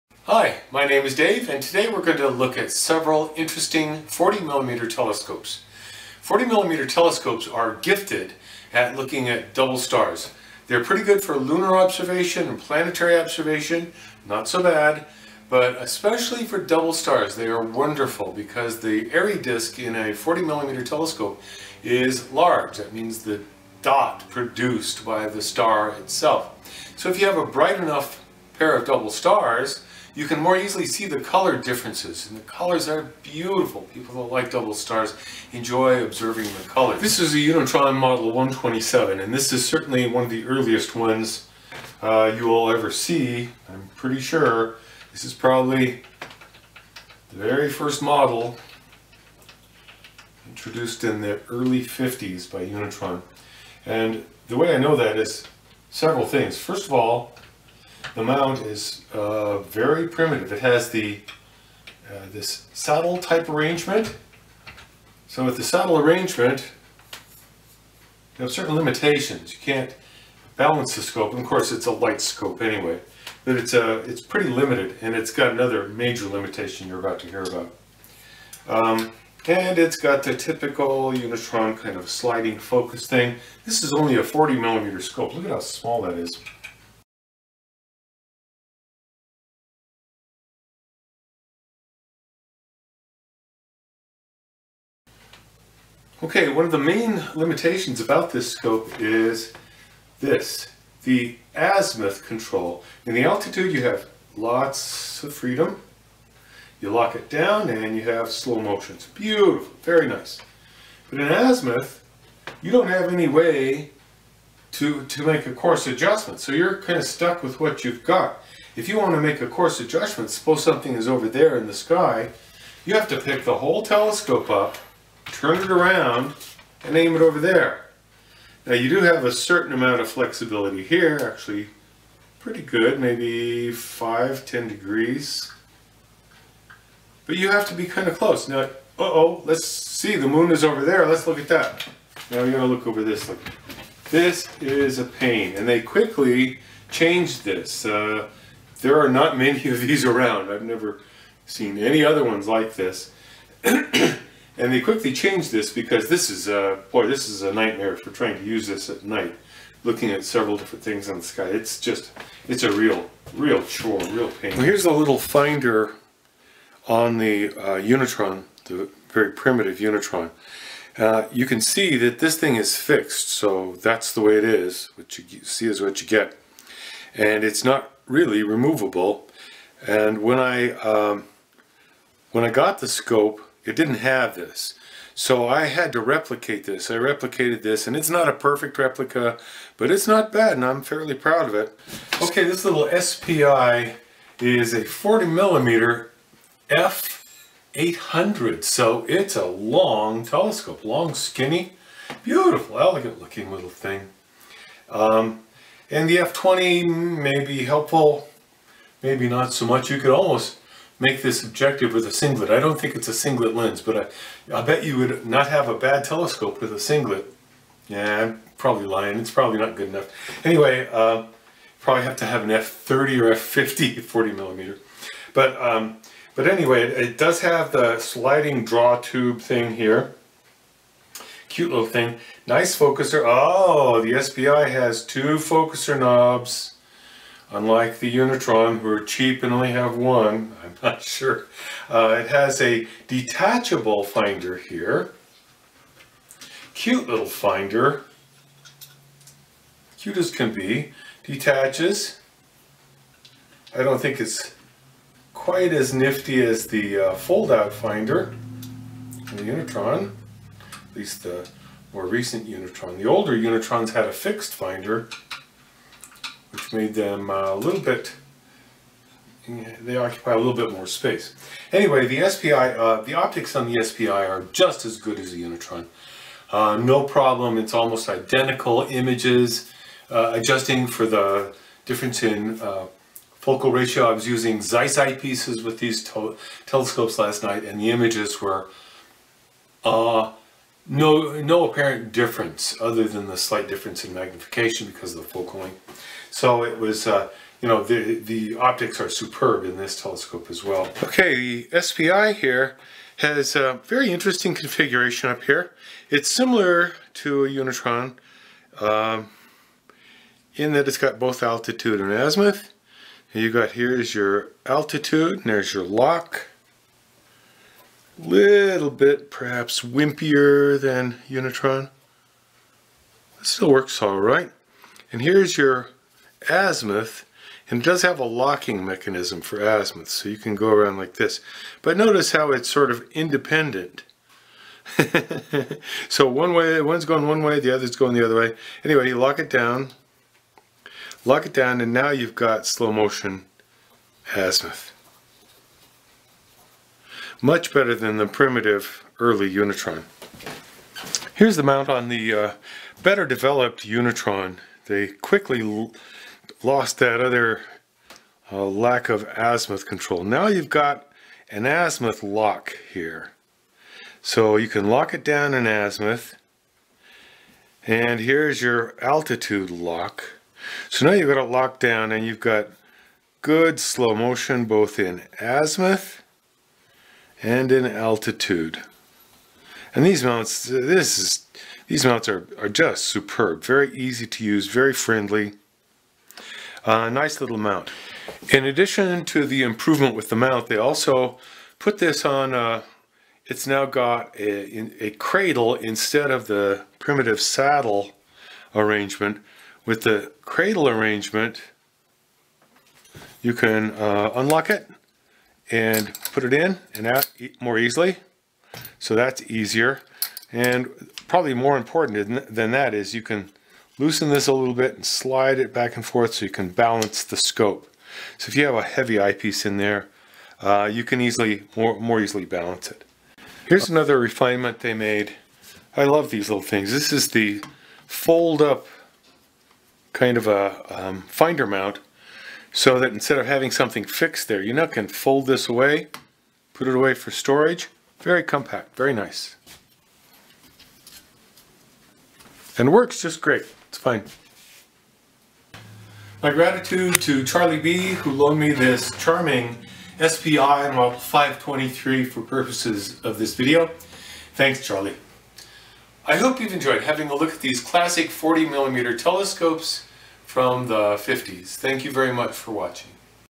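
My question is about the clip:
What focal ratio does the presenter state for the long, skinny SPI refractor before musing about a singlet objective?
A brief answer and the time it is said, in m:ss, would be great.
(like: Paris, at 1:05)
f20, at 3:26.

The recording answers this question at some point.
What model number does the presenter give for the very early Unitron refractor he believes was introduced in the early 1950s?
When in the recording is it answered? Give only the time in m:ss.
0:37.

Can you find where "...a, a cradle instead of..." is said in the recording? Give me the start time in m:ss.
6:34.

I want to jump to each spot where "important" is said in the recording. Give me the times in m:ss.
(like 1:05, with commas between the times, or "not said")
6:51.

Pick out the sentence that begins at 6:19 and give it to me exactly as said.
And these mounts, this is, these mounts are, are just superb.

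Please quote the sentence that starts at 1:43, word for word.
In the altitude you have lots of freedom.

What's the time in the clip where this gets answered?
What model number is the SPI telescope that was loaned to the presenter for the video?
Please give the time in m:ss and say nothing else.
7:30.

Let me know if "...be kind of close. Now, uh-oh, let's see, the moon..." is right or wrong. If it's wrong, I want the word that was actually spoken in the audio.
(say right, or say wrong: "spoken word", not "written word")
right.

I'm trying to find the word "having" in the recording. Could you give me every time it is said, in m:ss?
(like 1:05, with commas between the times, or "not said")
7:13, 7:37.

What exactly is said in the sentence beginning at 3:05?
So I had to replicate this.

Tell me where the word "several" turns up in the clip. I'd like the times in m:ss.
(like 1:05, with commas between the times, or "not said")
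0:02, 0:55, 2:40.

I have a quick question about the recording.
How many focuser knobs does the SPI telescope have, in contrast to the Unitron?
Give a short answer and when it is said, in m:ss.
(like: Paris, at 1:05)
2, at 3:55.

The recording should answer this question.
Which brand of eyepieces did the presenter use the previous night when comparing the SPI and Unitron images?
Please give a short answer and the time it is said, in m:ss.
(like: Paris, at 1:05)
Zeiss, at 4:44.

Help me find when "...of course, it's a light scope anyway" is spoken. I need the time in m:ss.
1:11.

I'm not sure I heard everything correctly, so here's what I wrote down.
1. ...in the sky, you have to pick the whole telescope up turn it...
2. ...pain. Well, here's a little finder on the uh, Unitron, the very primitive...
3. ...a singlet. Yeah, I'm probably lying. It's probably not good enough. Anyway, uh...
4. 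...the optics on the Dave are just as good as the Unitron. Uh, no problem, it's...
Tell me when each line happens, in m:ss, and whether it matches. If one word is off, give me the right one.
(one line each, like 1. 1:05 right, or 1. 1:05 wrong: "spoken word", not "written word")
1. 2:01 right
2. 2:44 right
3. 3:36 right
4. 4:33 wrong: "SPI", not "Dave".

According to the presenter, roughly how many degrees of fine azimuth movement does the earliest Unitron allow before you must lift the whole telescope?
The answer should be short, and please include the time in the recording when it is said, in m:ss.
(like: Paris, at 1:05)
5 to 10 degrees, at 2:13.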